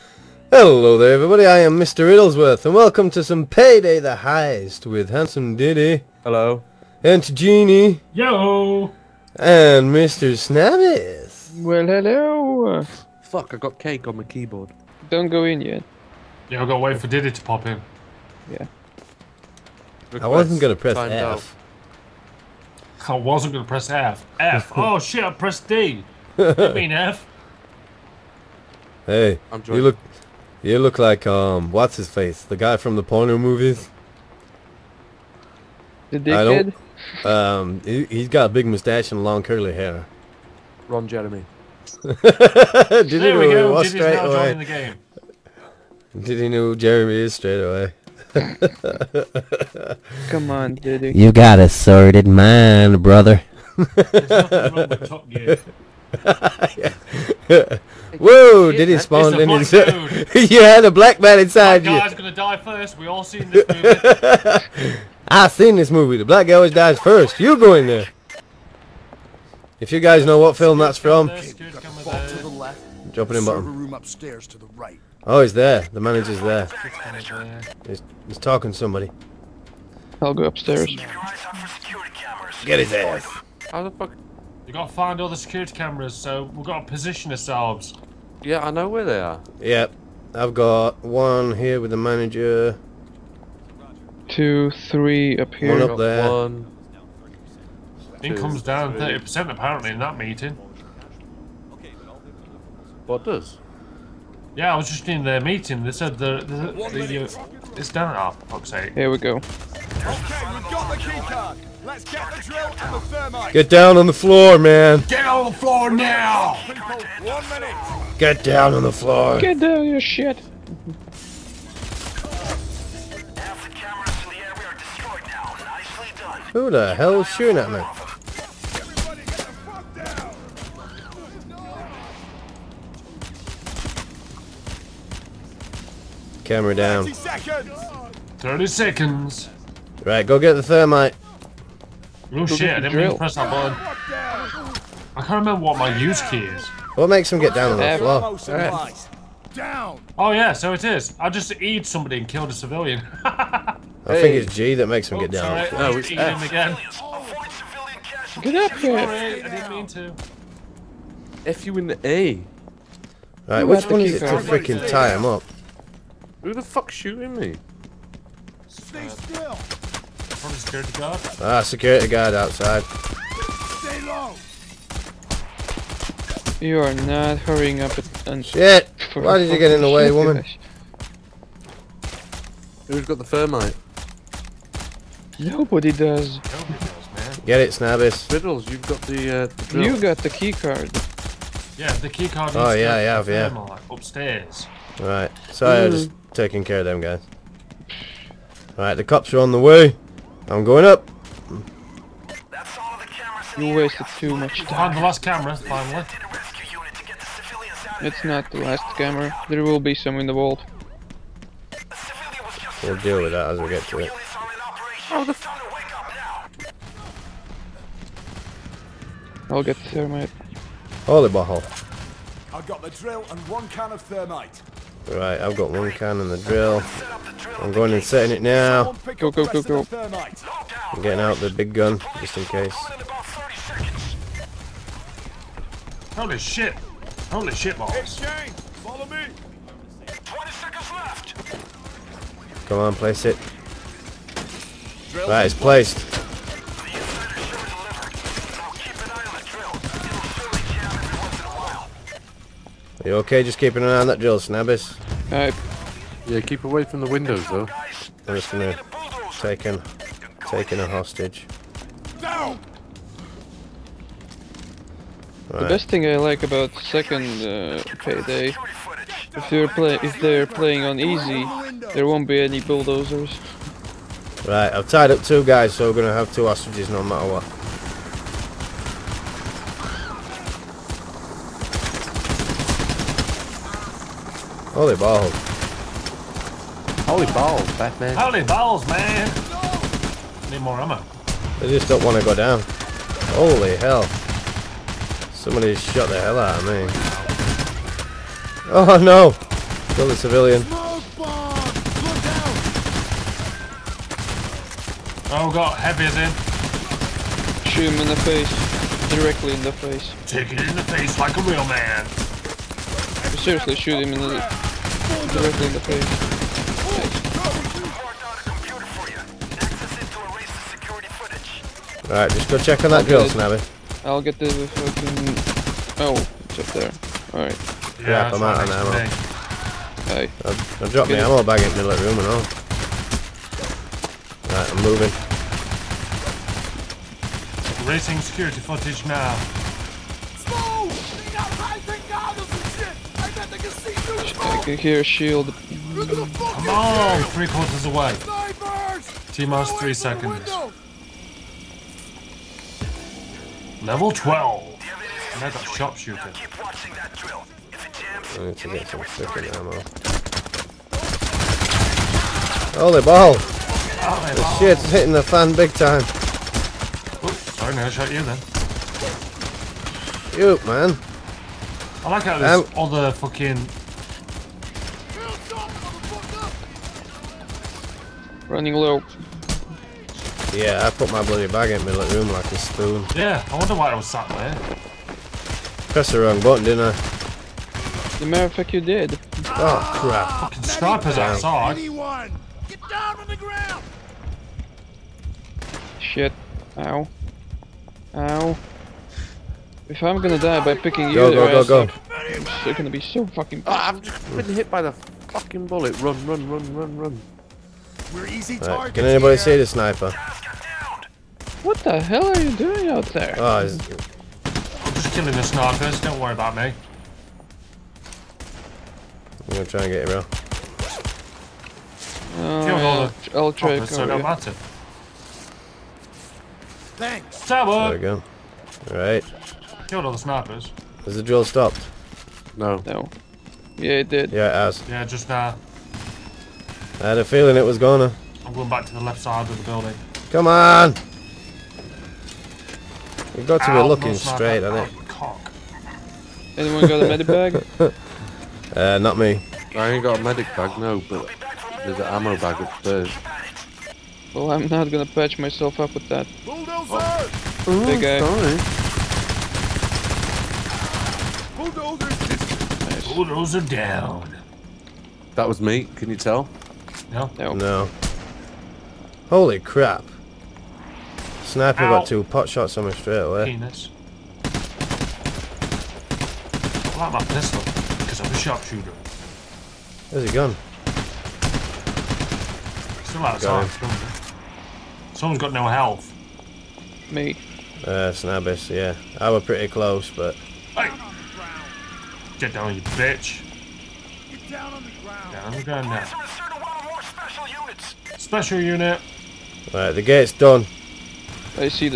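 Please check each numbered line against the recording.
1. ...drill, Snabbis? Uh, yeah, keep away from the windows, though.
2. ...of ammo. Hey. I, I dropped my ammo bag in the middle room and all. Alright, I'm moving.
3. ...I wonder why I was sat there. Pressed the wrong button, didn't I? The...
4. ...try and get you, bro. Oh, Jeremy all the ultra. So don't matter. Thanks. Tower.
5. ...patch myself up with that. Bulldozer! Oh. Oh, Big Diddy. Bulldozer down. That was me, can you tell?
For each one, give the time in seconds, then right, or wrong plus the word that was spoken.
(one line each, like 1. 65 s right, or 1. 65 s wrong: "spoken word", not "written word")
1. 254 s right
2. 328 s right
3. 383 s right
4. 419 s wrong: "Kill", not "Jeremy"
5. 455 s wrong: "Sorry", not "Diddy".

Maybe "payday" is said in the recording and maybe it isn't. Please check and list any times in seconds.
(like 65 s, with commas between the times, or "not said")
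3 s, 267 s.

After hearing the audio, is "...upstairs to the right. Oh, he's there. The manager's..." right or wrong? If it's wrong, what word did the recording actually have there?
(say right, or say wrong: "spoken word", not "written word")
right.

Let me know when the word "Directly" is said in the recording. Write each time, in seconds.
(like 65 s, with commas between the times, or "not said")
309 s, 315 s.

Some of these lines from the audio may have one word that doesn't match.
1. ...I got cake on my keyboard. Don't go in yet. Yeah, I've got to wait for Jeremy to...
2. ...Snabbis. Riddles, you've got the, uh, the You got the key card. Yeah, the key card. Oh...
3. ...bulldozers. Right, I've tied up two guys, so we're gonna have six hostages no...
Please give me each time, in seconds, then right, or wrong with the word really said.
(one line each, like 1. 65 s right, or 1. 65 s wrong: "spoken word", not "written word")
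1. 13 s wrong: "Diddy", not "Jeremy"
2. 187 s right
3. 272 s wrong: "two", not "six".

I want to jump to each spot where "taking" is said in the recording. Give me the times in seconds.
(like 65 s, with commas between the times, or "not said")
196 s, 260 s.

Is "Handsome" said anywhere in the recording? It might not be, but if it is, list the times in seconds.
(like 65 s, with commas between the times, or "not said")
5 s.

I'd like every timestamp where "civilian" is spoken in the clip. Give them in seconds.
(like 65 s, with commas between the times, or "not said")
152 s, 300 s.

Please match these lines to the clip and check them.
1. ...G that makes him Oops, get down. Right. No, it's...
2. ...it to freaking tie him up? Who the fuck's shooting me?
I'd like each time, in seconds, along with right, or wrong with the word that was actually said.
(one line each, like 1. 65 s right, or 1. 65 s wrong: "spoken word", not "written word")
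1. 154 s right
2. 164 s right.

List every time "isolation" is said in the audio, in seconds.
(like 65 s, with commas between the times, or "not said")
not said.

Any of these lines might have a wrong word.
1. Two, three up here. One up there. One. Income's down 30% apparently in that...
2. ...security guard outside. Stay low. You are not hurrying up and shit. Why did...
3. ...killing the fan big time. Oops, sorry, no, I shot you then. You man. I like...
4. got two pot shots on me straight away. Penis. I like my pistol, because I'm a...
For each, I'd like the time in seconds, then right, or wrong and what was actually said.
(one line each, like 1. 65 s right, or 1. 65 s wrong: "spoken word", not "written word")
1. 94 s right
2. 171 s right
3. 364 s wrong: "hitting", not "killing"
4. 471 s right.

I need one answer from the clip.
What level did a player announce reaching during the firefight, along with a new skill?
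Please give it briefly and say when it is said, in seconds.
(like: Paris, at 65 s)
12, at 353 s.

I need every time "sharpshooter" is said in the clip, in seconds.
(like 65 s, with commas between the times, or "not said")
355 s, 478 s.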